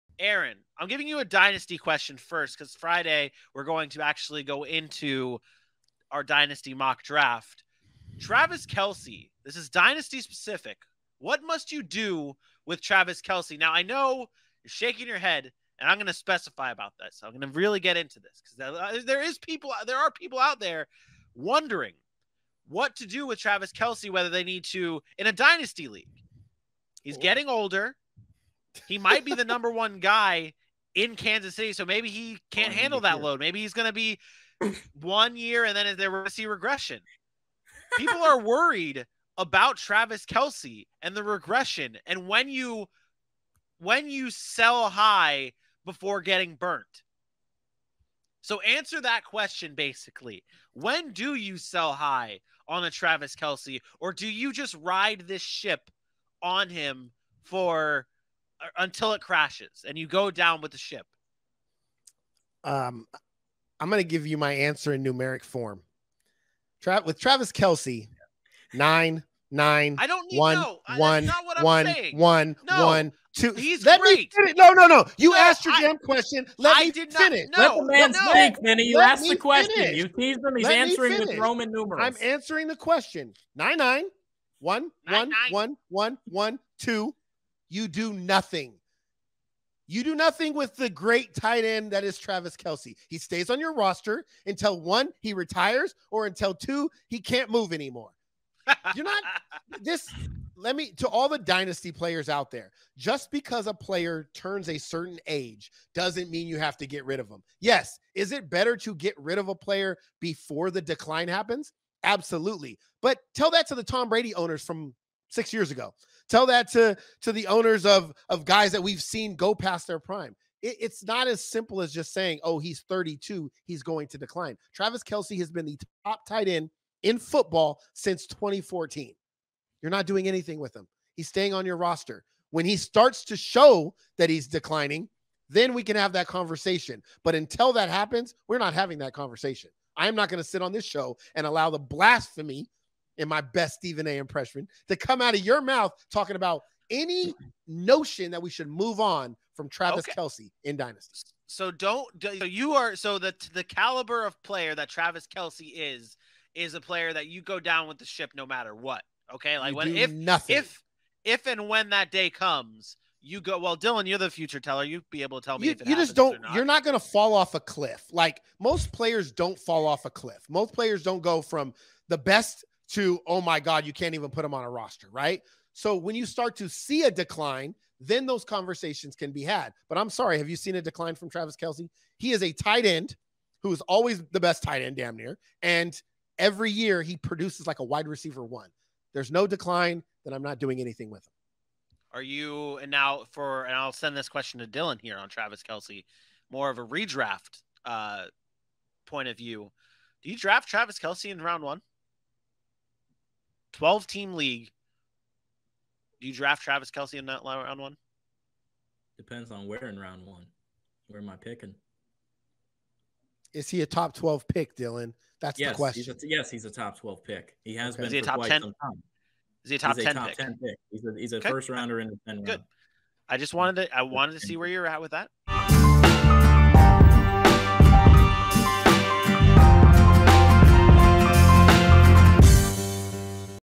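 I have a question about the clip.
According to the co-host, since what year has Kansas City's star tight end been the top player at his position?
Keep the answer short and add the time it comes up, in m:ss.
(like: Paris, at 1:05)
2014, at 2:08.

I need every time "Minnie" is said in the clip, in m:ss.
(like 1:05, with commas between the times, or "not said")
1:18.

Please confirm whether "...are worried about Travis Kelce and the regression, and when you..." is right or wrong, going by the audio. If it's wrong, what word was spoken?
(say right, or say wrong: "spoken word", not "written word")
right.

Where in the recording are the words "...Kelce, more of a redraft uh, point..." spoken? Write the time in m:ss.
3:15.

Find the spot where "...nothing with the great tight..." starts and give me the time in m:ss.
1:30.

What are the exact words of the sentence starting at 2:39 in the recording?
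Okay, like you when if nothing.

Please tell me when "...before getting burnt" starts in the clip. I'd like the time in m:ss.
0:45.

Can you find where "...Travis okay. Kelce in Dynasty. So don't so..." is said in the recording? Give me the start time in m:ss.
2:29.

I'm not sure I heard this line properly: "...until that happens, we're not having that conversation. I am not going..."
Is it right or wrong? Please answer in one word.
right.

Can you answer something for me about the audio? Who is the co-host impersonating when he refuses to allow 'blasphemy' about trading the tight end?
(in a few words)
Stephen A.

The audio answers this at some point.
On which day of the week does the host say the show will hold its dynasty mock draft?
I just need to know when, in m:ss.
0:02.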